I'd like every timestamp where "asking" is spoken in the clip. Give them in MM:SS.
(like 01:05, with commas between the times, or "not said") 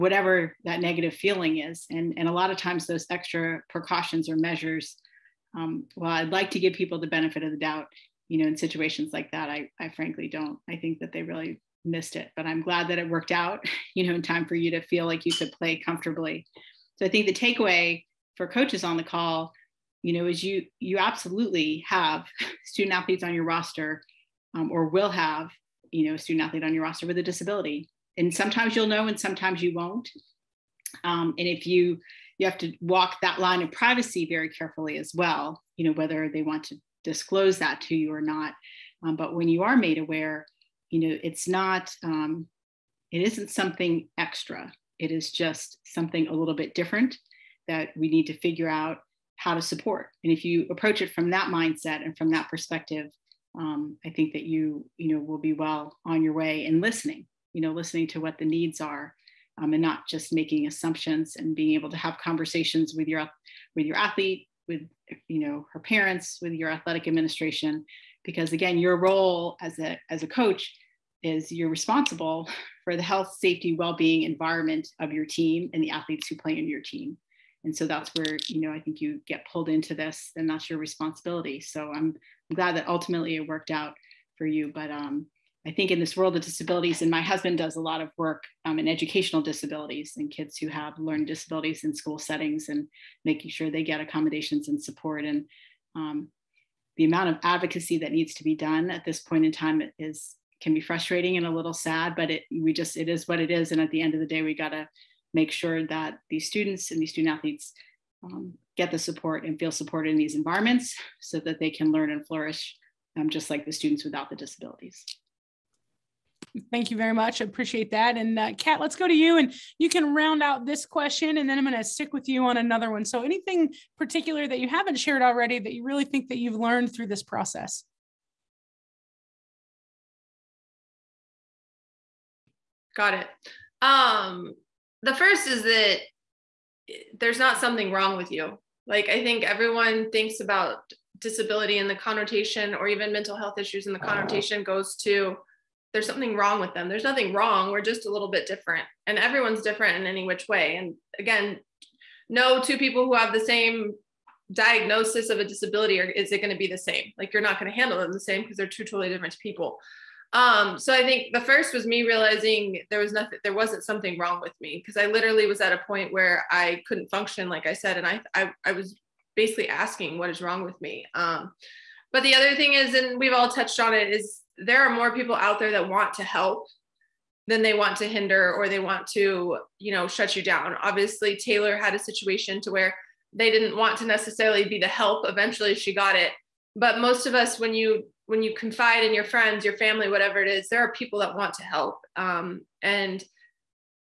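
02:49.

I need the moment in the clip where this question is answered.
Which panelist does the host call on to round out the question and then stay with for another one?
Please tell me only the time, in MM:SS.
01:58.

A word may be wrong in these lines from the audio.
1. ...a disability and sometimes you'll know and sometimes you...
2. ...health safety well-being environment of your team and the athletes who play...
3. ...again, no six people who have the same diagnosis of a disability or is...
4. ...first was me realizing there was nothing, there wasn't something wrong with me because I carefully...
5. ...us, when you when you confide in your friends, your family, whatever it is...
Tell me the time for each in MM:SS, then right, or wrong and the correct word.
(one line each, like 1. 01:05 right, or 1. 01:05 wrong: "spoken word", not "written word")
1. 00:27 right
2. 01:13 right
3. 02:31 wrong: "two", not "six"
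4. 02:41 wrong: "literally", not "carefully"
5. 03:07 right.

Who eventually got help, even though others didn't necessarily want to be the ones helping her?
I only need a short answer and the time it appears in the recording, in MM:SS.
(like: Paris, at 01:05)
Taylor, at 03:01.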